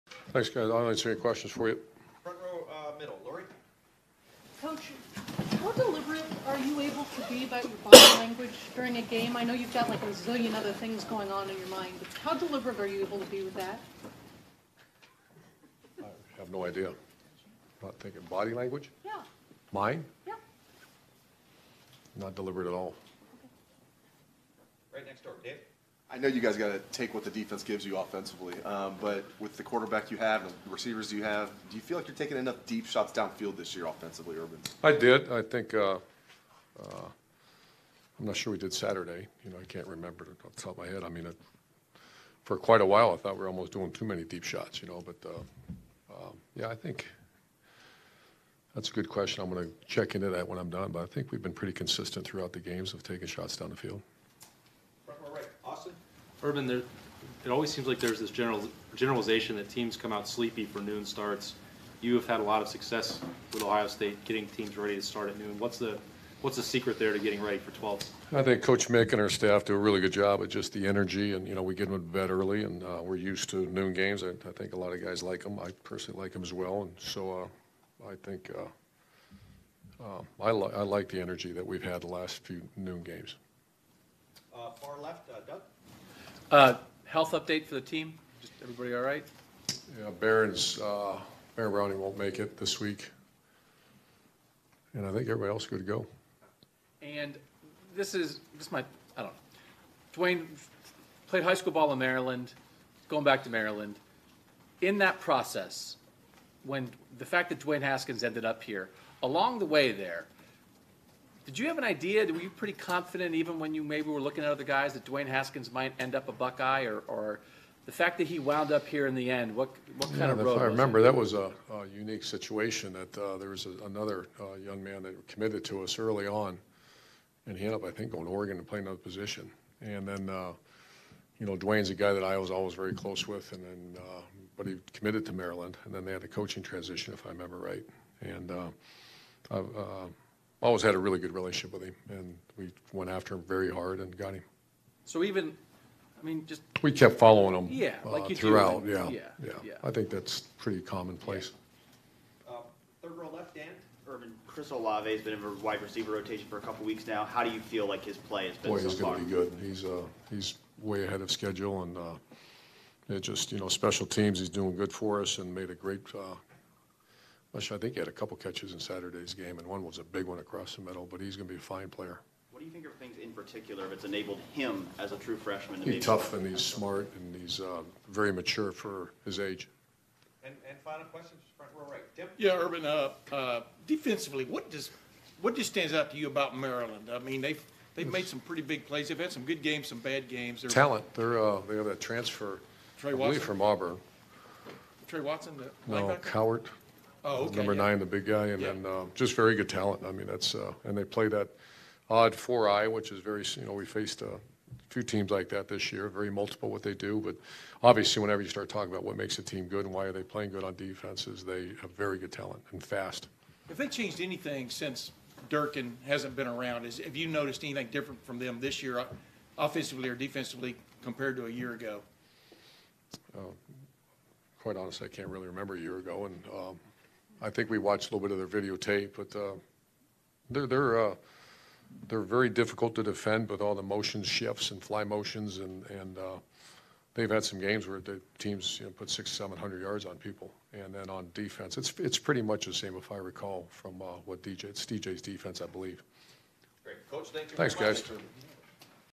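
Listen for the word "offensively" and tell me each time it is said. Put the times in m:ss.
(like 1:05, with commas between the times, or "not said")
0:27, 0:33, 3:39.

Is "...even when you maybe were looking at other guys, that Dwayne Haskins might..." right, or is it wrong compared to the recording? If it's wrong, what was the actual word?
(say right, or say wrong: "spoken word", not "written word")
right.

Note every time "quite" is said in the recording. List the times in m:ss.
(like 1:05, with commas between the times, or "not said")
0:42, 3:44.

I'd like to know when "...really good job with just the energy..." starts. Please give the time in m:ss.
1:09.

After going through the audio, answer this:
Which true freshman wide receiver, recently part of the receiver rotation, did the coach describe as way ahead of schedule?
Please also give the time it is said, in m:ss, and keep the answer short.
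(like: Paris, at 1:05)
Chris Olave, at 2:34.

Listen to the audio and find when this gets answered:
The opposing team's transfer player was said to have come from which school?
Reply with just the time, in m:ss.
3:13.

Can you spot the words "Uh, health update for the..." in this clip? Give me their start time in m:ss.
1:26.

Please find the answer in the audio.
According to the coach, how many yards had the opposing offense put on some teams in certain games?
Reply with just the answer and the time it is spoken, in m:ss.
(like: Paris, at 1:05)
600 to 700, at 3:59.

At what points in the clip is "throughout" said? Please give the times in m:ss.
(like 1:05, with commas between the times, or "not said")
0:52, 2:28.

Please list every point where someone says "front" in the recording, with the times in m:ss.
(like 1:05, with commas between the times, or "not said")
0:02, 3:01.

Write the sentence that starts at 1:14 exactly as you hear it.
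I, I, think a lot of guys like them.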